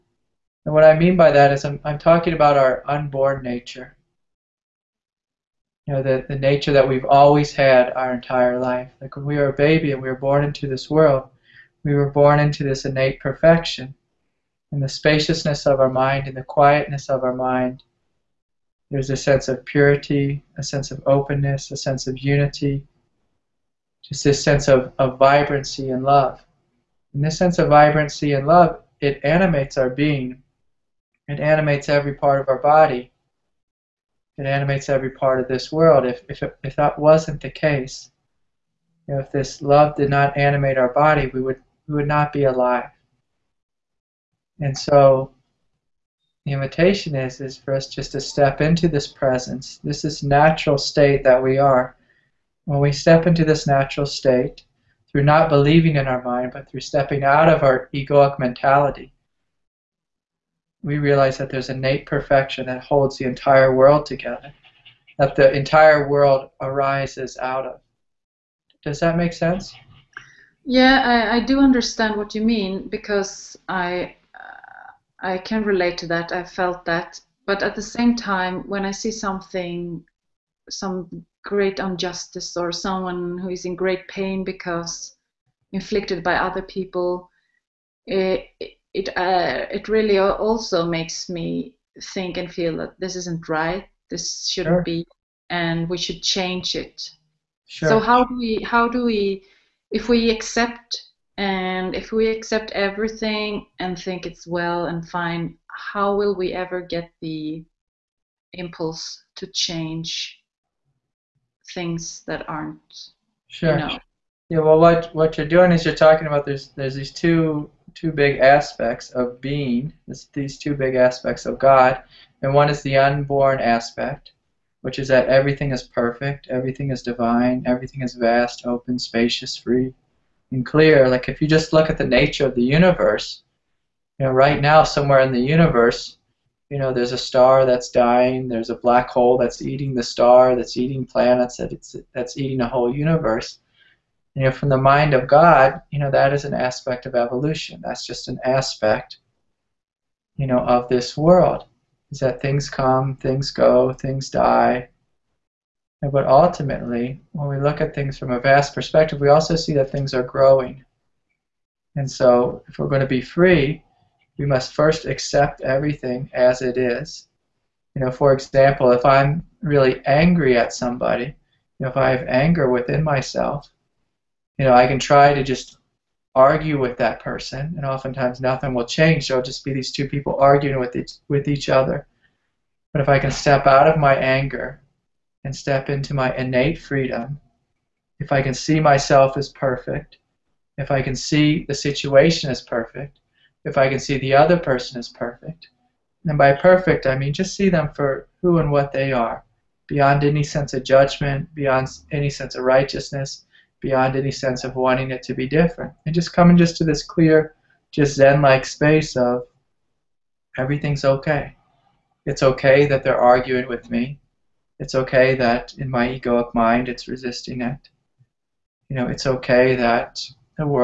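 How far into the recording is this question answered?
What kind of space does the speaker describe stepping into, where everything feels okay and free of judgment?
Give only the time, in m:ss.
3:28.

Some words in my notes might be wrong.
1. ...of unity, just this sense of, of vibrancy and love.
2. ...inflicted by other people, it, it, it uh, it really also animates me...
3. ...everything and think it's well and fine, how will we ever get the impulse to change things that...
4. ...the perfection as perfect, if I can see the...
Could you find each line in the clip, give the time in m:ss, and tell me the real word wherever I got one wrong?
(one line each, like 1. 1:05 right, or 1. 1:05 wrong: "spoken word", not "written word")
1. 0:22 right
2. 1:25 wrong: "makes", not "animates"
3. 1:42 right
4. 3:11 wrong: "situation", not "perfection".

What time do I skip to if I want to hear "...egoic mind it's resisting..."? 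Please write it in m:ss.
3:36.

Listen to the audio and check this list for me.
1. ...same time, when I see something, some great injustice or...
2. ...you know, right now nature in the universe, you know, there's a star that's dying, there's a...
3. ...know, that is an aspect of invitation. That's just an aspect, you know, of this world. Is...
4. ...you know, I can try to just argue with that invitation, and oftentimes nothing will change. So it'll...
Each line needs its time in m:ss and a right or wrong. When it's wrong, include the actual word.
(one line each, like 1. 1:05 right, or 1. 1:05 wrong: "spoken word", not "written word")
1. 1:17 right
2. 2:14 wrong: "somewhere", not "nature"
3. 2:25 wrong: "evolution", not "invitation"
4. 2:54 wrong: "person", not "invitation".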